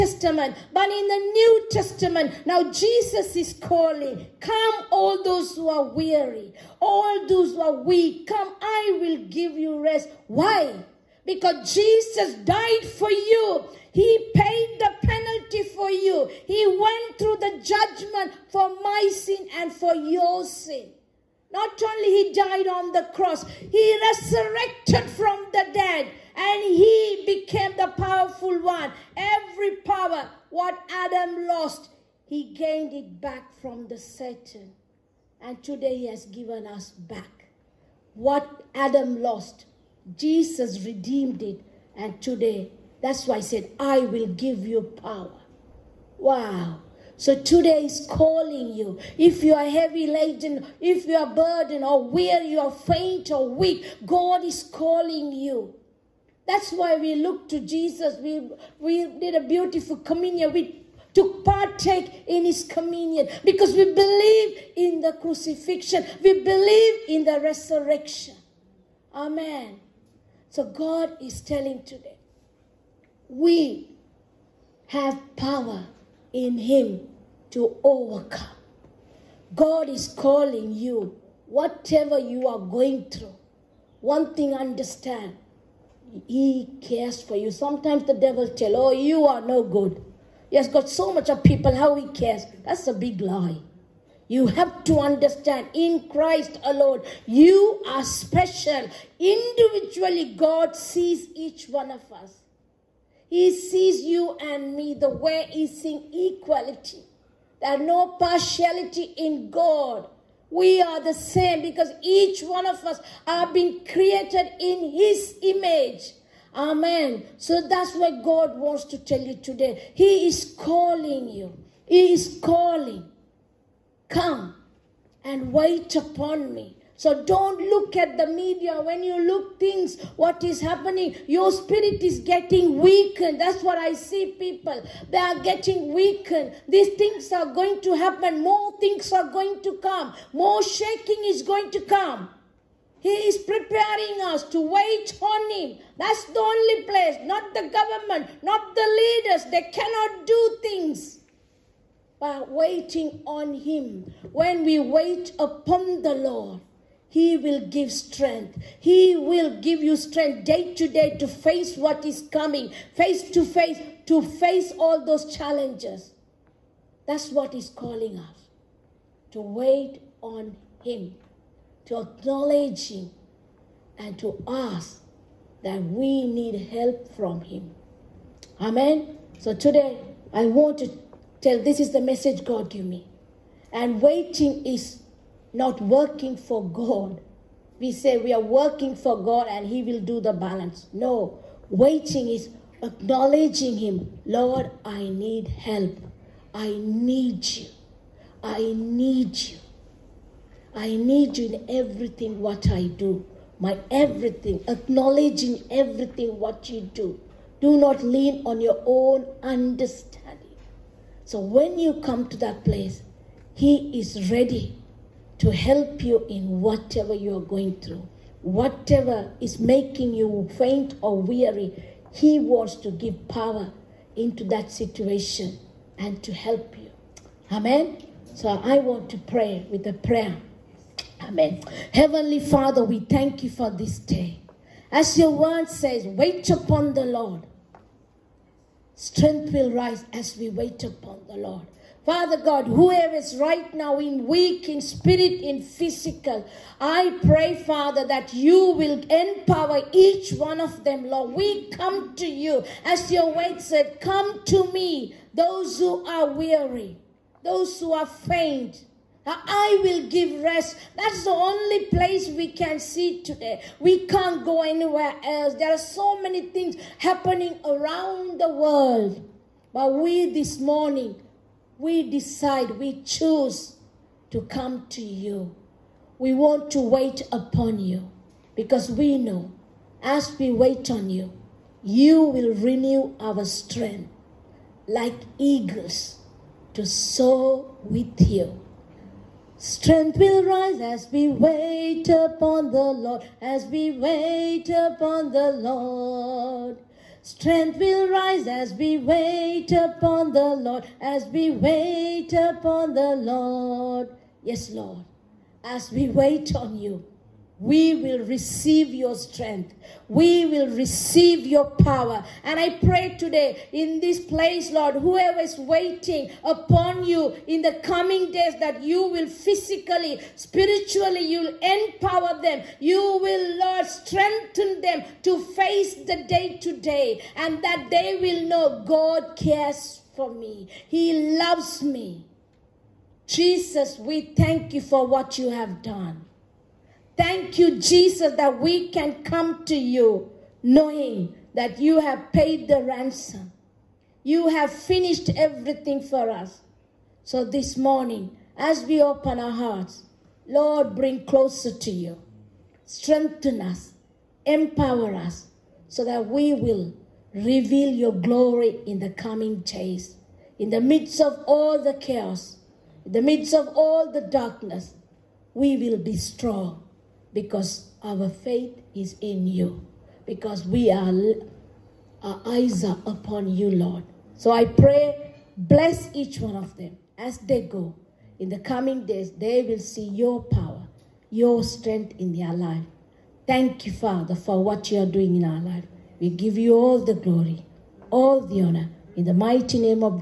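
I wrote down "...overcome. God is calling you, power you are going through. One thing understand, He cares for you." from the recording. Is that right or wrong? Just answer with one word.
wrong.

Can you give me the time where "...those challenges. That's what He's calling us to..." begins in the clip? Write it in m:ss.
2:45.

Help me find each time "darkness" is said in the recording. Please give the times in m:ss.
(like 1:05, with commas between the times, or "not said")
6:04.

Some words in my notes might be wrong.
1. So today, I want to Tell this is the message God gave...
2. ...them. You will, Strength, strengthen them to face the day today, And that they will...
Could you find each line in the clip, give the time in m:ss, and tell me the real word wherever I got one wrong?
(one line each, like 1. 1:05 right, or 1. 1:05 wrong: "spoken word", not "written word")
1. 2:59 right
2. 5:22 wrong: "Lord", not "Strength".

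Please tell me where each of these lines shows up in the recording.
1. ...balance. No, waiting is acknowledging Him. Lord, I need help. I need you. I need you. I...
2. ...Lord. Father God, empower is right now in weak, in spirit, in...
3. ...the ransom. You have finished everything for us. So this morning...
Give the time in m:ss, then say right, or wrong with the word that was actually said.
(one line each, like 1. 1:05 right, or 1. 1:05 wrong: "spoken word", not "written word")
1. 3:10 right
2. 4:01 wrong: "whoever", not "empower"
3. 5:42 right.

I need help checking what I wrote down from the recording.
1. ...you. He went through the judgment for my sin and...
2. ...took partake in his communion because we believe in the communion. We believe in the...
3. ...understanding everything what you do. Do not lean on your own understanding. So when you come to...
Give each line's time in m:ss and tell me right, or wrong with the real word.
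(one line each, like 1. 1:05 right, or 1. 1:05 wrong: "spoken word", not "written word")
1. 0:15 right
2. 1:01 wrong: "crucifixion", not "communion"
3. 3:24 wrong: "acknowledging", not "understanding".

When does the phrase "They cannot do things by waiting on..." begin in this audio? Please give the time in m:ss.
2:29.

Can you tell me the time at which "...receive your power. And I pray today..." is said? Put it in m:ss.
5:10.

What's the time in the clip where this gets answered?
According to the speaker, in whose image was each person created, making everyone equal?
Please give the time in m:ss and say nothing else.
1:54.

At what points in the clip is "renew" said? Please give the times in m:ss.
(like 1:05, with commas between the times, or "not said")
4:42.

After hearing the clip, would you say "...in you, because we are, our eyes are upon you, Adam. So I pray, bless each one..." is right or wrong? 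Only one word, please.
wrong.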